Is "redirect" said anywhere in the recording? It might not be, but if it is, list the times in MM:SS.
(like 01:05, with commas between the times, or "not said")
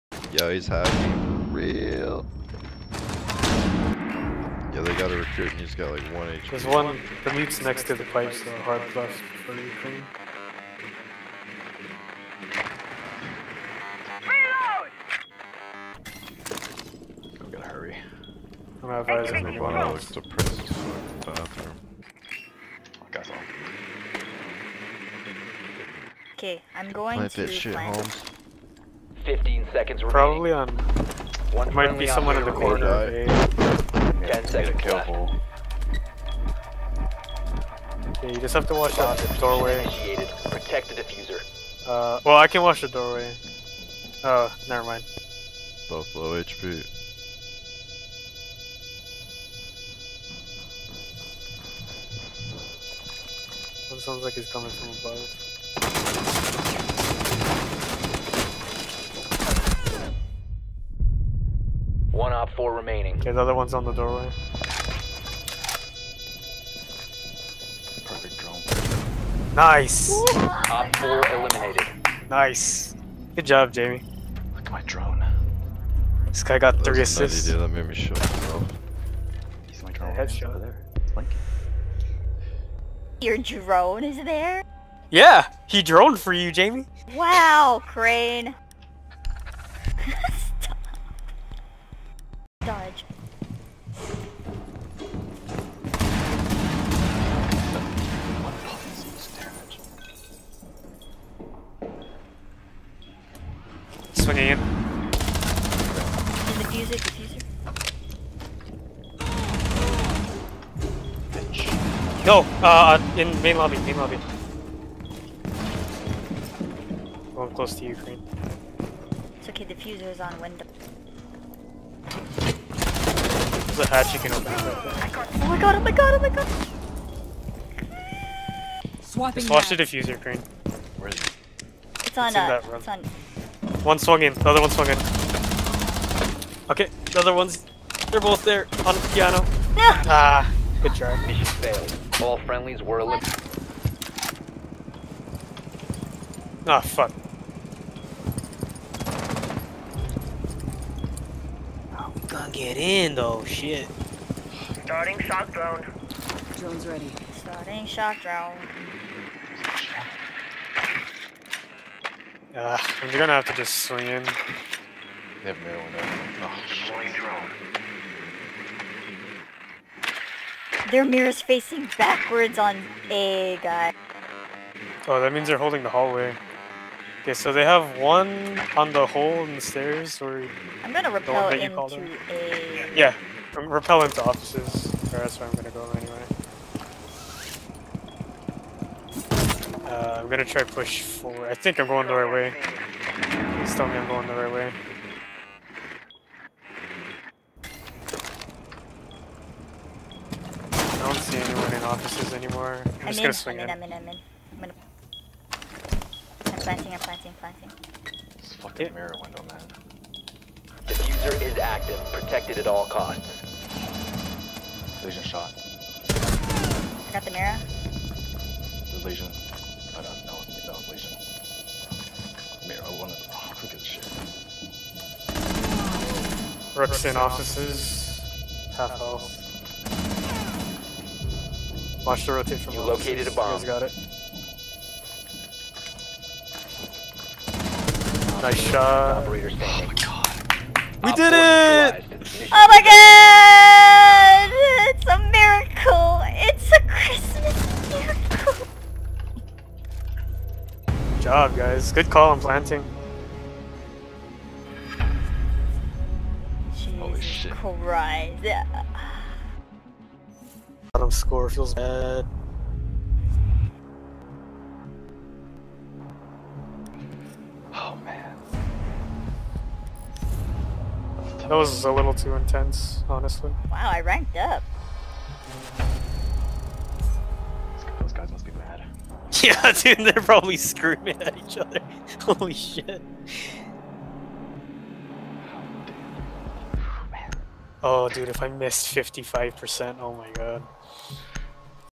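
not said.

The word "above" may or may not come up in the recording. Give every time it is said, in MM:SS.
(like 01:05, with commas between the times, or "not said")
00:54.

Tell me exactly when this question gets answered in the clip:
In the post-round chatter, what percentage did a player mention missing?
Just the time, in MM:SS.
04:48.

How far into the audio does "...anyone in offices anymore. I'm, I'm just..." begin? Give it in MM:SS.
03:21.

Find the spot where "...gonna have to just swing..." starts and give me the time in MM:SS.
02:43.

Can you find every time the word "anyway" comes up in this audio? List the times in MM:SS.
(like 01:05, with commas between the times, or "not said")
03:09.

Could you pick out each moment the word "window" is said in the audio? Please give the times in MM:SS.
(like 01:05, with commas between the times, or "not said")
02:00, 03:29.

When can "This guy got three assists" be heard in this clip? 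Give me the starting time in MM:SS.
01:16.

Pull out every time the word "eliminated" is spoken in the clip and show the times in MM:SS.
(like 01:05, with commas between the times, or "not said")
01:11, 02:22.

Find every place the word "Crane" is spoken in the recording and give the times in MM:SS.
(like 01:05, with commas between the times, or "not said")
01:27, 02:10.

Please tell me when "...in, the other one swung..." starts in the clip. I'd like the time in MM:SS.
02:14.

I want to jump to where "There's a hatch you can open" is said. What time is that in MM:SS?
02:03.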